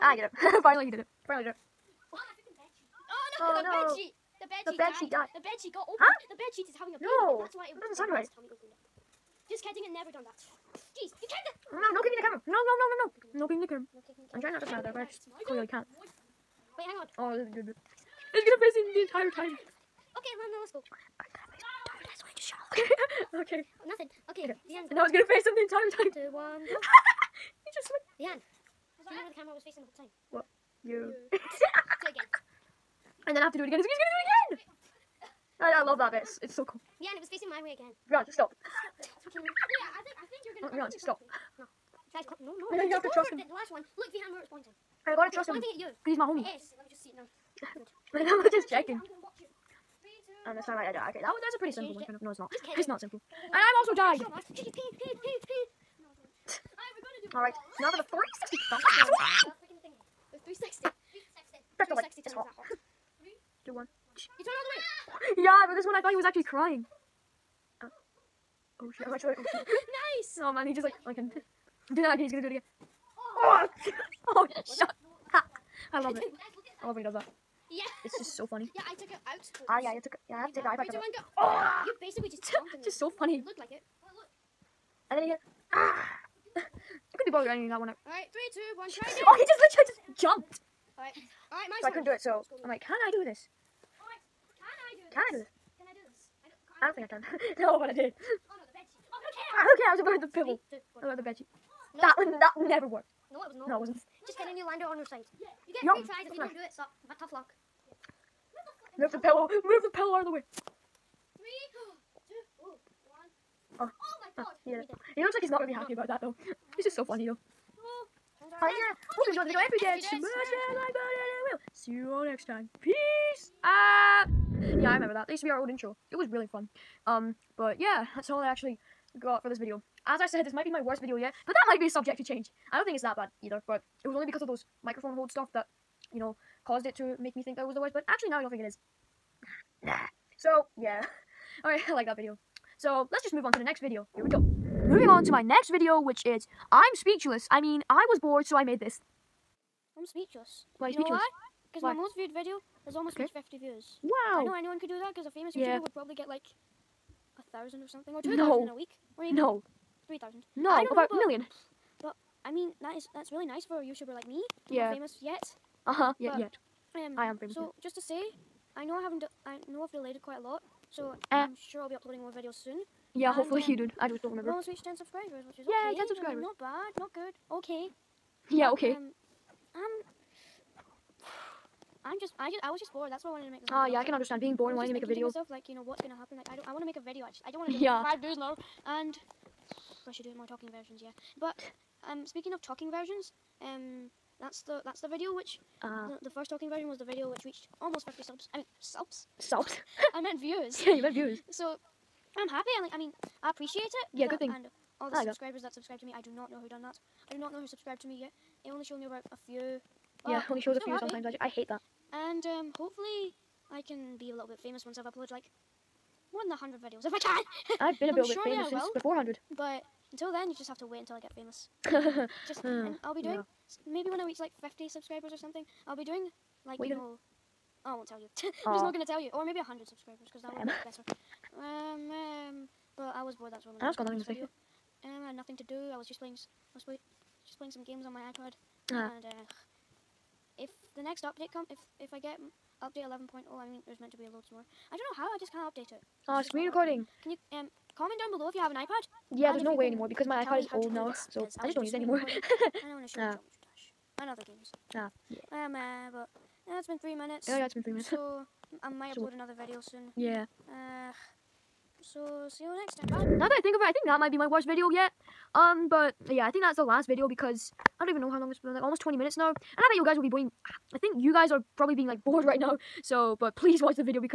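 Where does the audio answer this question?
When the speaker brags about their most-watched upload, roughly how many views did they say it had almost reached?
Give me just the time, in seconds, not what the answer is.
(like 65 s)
153 s.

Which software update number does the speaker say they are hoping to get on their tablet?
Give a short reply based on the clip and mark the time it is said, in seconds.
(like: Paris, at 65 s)
11.0, at 242 s.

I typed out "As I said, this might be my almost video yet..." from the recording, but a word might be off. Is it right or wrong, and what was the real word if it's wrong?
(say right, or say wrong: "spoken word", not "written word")
wrong: "worst", not "almost".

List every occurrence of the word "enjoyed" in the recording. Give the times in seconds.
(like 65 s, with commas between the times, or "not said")
119 s.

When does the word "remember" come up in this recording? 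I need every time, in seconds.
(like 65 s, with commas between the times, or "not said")
29 s, 124 s, 174 s.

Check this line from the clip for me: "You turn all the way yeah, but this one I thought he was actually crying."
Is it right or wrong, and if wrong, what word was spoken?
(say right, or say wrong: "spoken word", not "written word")
right.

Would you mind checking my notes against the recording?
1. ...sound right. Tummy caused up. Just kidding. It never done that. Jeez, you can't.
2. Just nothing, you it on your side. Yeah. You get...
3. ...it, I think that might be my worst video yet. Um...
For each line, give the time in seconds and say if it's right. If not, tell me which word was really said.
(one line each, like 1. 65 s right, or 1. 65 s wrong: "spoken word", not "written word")
1. 7 s wrong: "opened", not "caused"
2. 104 s wrong: "kidding", not "nothing"
3. 263 s right.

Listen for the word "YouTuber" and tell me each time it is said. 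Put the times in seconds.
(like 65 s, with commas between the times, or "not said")
155 s, 163 s.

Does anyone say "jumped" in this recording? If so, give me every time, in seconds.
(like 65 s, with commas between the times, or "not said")
82 s, 90 s.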